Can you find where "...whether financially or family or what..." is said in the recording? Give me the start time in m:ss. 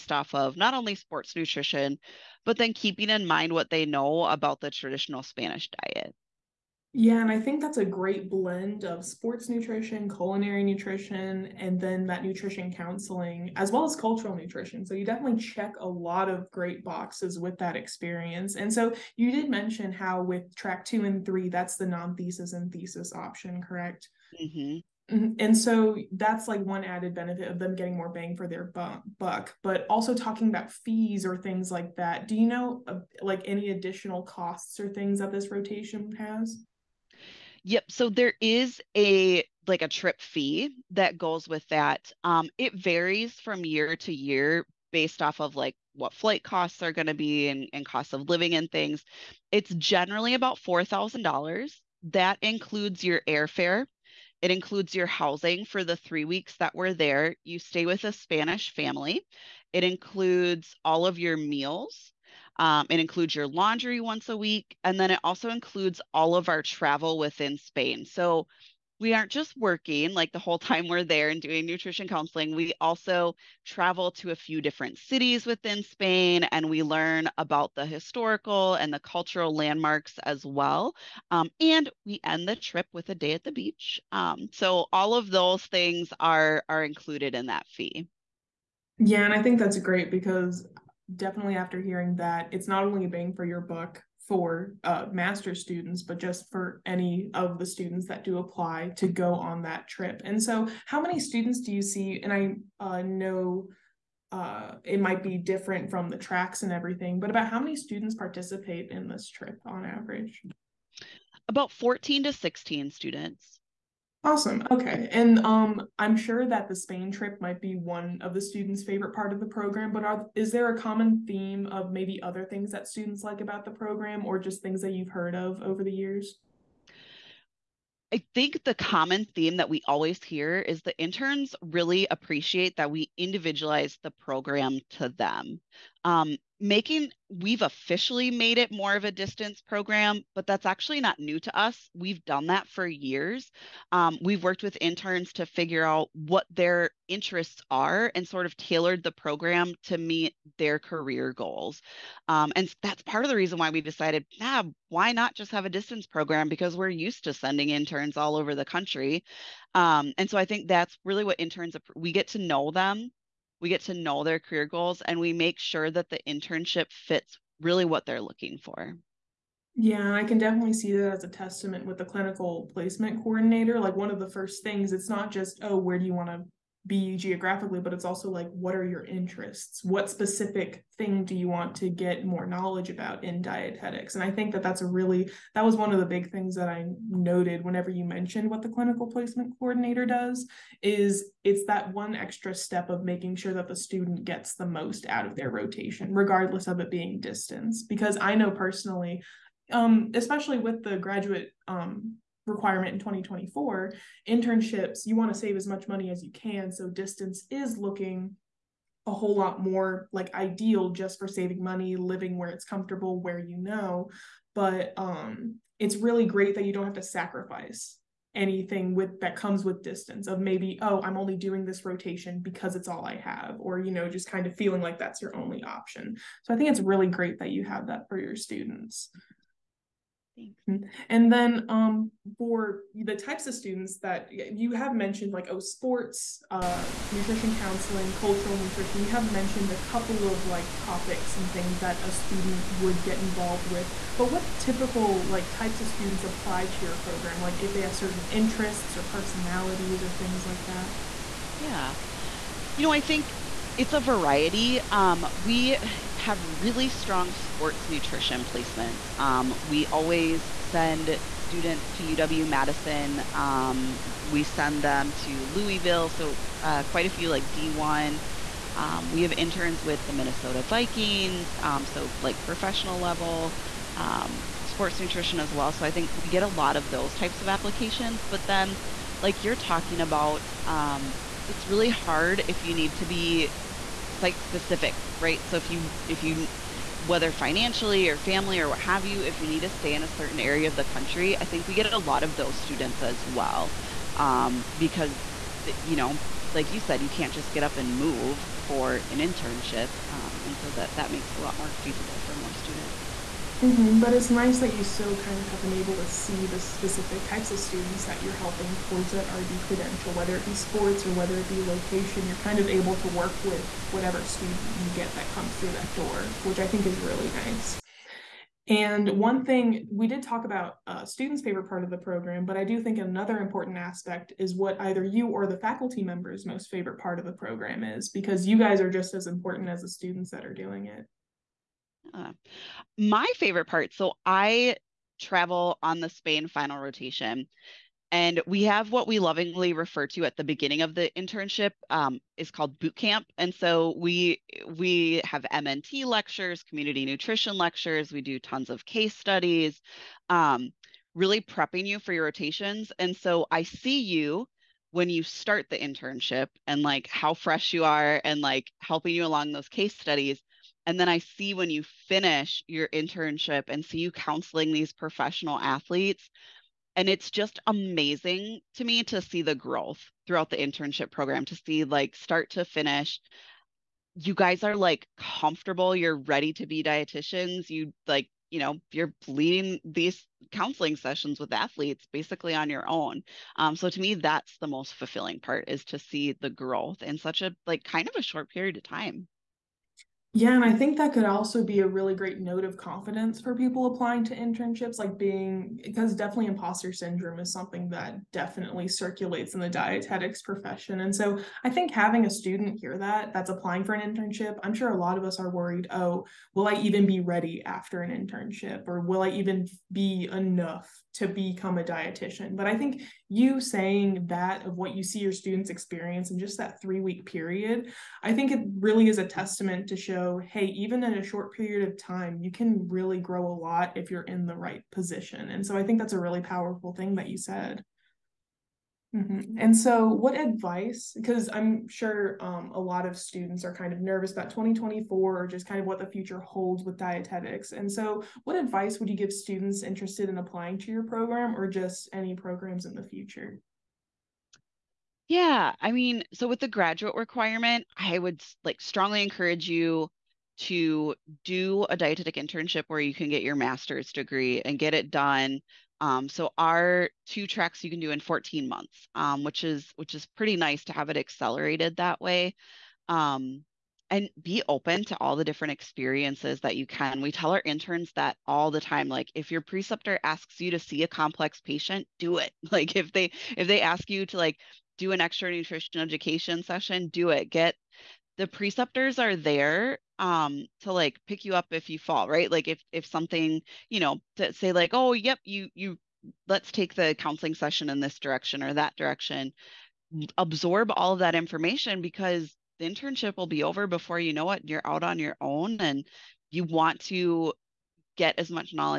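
4:47.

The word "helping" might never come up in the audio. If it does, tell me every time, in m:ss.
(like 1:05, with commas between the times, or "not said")
5:08, 5:58.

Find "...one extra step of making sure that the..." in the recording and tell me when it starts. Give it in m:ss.
3:11.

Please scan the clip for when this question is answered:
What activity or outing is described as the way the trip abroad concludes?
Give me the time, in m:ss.
1:23.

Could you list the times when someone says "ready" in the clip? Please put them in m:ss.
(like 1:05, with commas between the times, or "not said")
6:16, 6:47.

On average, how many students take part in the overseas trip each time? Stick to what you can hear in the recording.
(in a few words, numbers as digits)
14 to 16.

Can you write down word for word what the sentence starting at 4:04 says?
But what typical like types of students apply to your program?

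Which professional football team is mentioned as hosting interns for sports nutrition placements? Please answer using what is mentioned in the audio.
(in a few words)
Minnesota Vikings.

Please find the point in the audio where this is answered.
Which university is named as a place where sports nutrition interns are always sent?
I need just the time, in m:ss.
4:22.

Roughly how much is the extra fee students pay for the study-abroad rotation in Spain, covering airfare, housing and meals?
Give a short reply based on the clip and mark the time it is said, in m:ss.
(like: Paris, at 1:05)
$4,000, at 0:50.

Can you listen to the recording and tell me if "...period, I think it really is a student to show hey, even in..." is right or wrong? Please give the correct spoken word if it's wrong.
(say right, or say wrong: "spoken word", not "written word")
wrong: "testament", not "student".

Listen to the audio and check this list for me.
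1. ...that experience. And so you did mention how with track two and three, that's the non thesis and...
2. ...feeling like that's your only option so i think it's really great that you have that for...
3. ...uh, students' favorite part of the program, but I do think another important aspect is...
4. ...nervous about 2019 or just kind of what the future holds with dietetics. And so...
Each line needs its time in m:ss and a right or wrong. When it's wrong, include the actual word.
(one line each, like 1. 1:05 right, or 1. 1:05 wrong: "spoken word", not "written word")
1. 0:17 right
2. 3:44 right
3. 5:20 right
4. 7:13 wrong: "2024", not "2019".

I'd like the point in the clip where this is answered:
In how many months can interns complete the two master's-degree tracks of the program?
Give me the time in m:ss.
7:38.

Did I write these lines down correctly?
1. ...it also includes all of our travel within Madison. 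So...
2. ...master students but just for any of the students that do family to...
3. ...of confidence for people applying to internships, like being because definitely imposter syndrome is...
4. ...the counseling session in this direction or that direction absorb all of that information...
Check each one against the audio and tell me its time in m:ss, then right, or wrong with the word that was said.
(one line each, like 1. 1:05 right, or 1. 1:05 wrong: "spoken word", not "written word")
1. 1:05 wrong: "Spain", not "Madison"
2. 1:35 wrong: "apply", not "family"
3. 6:32 right
4. 8:06 right.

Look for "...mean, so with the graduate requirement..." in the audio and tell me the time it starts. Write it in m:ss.
7:25.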